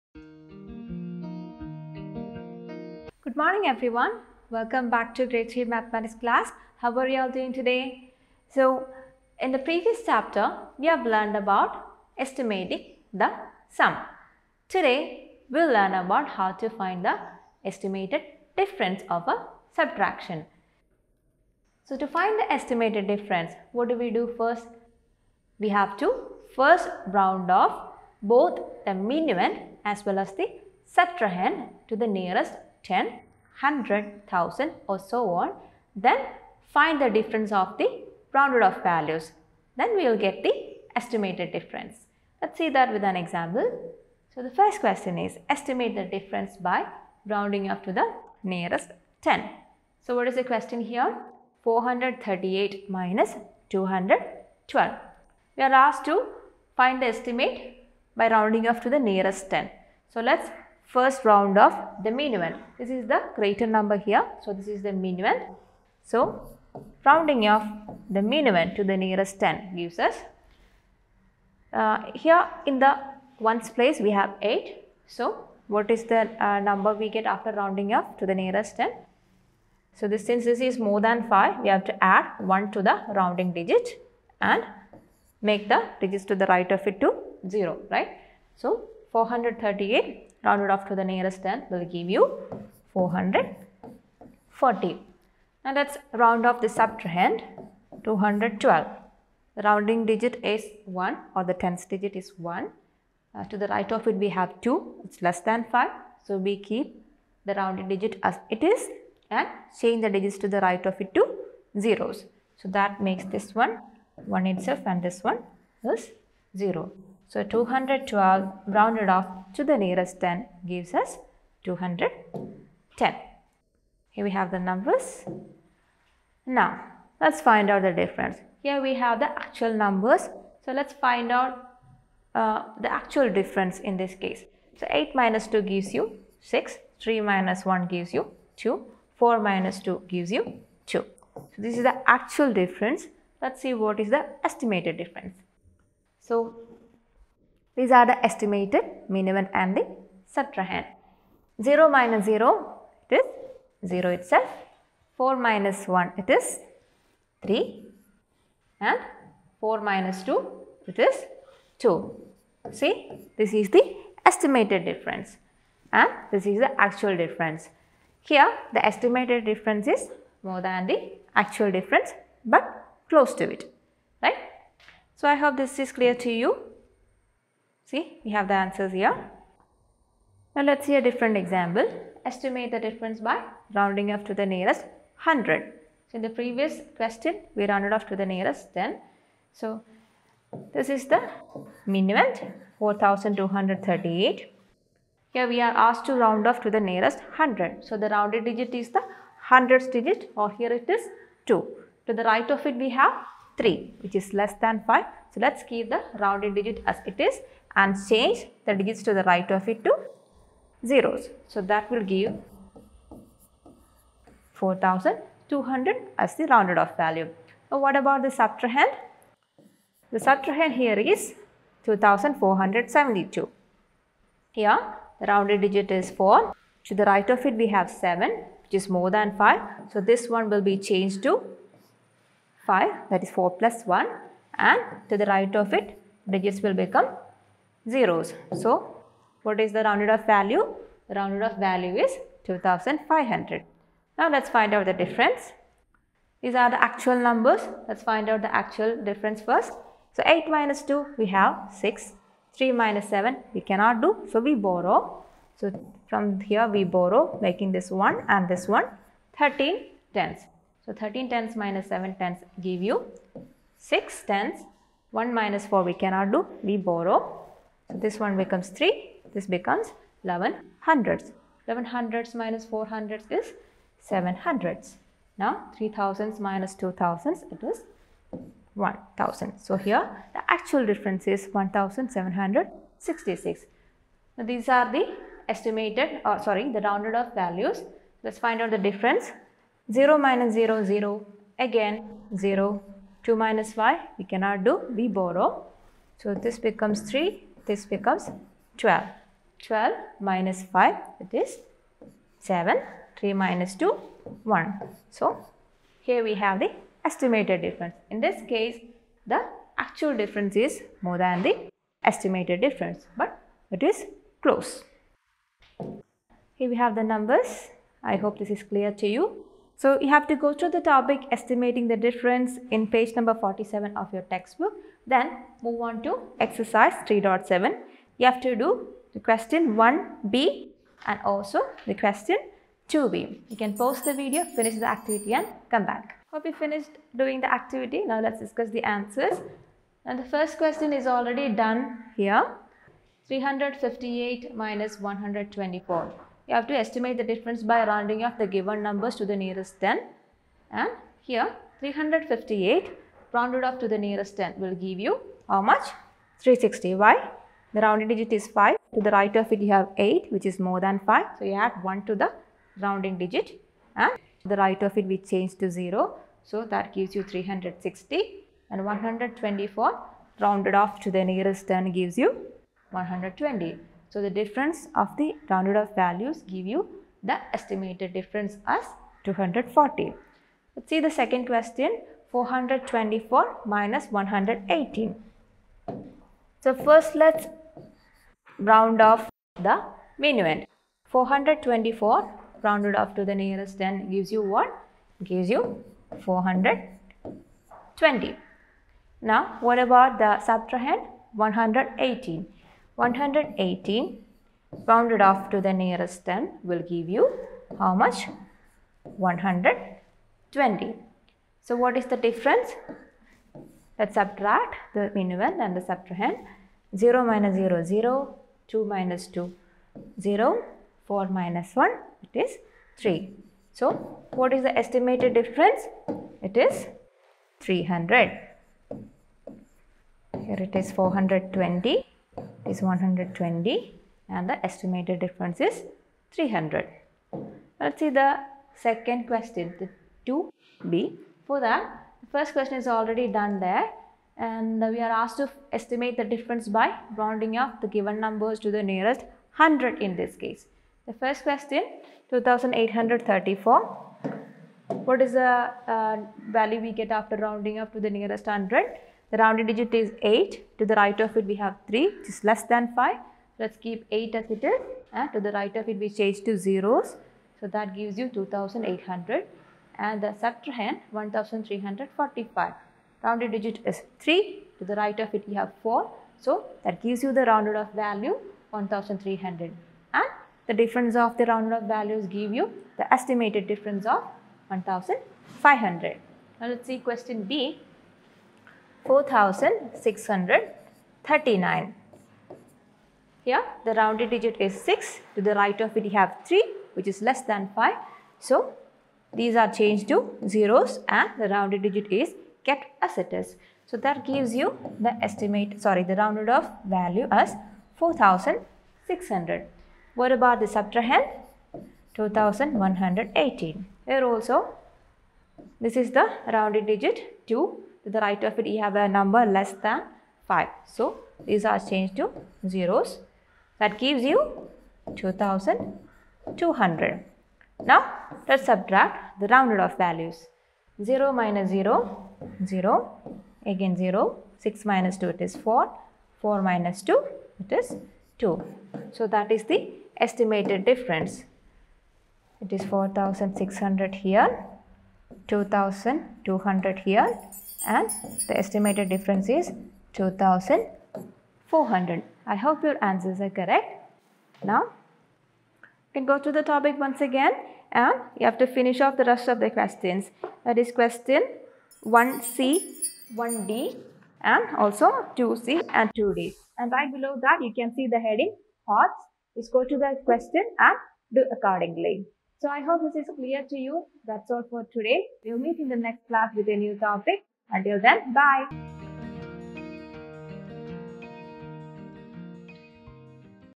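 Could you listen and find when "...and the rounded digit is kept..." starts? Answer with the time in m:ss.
8:21.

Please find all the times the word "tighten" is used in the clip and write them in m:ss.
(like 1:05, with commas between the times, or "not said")
not said.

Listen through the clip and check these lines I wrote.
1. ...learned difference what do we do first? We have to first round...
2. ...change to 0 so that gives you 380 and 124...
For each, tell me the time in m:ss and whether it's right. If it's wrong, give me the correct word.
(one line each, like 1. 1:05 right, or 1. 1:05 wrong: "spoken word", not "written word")
1. 0:22 wrong: "estimated", not "learned"
2. 6:05 wrong: "360", not "380".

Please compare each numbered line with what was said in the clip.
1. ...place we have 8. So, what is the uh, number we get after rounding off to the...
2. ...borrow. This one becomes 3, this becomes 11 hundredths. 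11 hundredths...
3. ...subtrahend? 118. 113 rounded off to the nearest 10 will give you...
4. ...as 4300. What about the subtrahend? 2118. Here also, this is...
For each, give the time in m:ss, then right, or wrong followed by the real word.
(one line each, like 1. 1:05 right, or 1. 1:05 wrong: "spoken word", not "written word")
1. 1:13 right
2. 4:26 right
3. 6:40 wrong: "118", not "113"
4. 8:27 wrong: "4600", not "4300".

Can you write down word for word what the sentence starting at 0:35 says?
Then find the difference of the rounded off values.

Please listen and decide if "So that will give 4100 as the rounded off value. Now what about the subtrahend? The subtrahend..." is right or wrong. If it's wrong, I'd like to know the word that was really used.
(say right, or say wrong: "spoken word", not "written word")
wrong: "4200", not "4100".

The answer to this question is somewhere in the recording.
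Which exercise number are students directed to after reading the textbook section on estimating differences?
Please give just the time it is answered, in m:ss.
5:26.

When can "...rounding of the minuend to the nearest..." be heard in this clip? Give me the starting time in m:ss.
1:07.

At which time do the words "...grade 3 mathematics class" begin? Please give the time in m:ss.
0:05.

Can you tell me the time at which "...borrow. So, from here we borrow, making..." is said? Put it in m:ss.
4:14.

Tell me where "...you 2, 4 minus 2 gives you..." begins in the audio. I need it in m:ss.
2:18.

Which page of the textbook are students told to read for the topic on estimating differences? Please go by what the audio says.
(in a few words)
47.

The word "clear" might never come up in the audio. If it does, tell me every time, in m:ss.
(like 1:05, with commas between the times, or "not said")
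2:55, 5:18, 9:33.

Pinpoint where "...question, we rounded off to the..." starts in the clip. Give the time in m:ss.
3:06.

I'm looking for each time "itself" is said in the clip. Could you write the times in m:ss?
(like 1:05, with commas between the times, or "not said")
1:54, 2:34.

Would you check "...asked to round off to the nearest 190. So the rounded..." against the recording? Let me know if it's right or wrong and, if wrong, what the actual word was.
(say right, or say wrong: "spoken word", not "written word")
wrong: "100", not "190".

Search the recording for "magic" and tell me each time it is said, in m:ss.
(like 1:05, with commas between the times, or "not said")
not said.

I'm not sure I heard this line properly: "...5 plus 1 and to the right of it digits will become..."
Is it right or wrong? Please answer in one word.
wrong.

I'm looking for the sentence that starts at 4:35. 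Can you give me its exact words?
Now 3 thousands minus 2 thousands it is 1000.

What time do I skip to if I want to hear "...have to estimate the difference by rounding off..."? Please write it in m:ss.
5:46.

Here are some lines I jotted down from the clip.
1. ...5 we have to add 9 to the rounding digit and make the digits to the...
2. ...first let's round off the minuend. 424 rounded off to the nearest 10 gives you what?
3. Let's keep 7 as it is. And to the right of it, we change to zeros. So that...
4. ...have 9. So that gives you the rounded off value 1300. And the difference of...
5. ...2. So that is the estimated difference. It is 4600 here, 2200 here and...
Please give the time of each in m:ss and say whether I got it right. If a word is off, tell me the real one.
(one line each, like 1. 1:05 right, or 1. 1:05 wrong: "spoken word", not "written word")
1. 1:21 wrong: "1", not "9"
2. 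6:26 right
3. 7:43 wrong: "8", not "7"
4. 7:55 wrong: "4", not "9"
5. 8:58 right.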